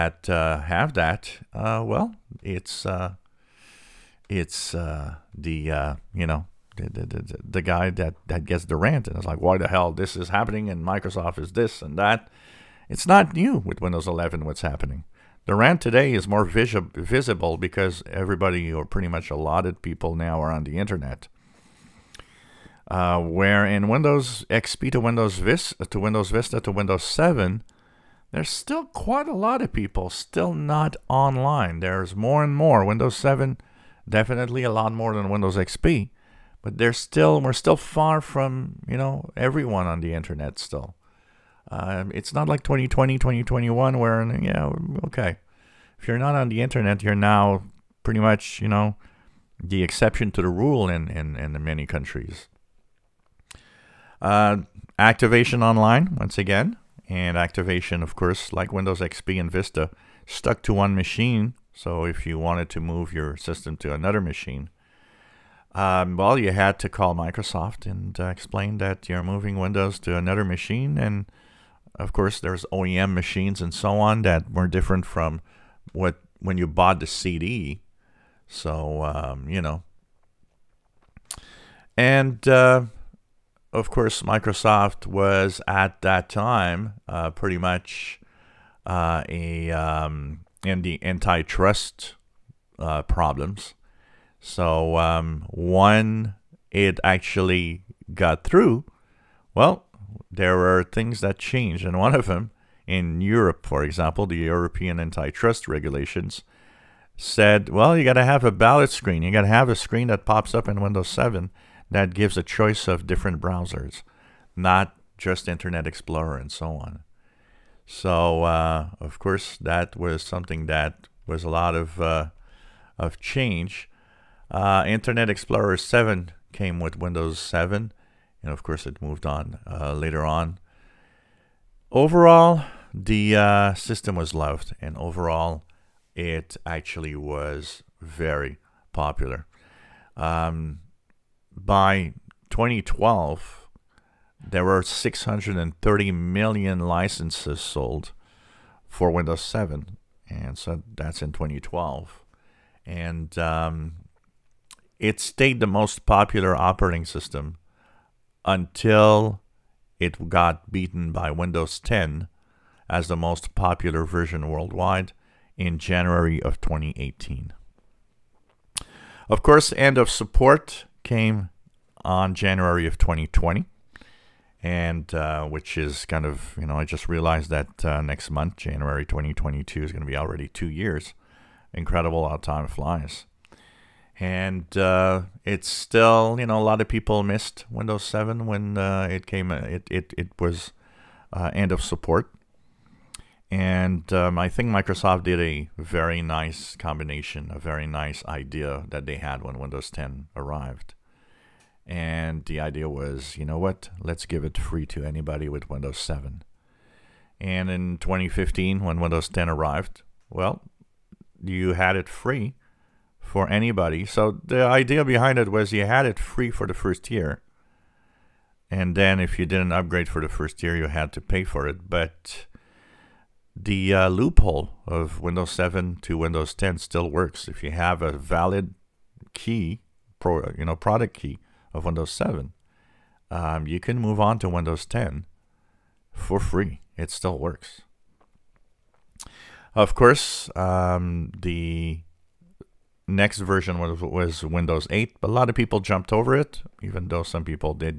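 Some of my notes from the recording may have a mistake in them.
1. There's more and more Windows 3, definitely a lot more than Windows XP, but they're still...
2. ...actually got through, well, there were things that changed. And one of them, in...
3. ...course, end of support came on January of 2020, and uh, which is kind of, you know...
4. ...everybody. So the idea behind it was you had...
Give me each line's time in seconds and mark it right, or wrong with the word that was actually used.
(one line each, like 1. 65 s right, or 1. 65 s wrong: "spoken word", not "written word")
1. 31 s wrong: "7", not "3"
2. 97 s right
3. 169 s right
4. 213 s wrong: "anybody", not "everybody".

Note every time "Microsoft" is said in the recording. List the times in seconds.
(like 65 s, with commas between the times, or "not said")
10 s, 67 s, 84 s, 194 s.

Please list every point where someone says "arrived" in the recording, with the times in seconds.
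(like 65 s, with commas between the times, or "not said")
200 s, 209 s.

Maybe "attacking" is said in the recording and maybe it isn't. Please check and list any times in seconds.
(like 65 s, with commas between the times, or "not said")
not said.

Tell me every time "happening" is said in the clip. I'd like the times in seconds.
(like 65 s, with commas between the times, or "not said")
10 s, 14 s.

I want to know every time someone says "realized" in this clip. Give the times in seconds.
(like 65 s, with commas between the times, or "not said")
177 s.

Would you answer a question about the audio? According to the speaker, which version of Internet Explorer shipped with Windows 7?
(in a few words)
Internet Explorer 7.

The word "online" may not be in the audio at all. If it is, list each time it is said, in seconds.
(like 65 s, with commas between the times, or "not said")
31 s, 55 s.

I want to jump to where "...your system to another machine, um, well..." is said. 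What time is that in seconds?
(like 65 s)
63 s.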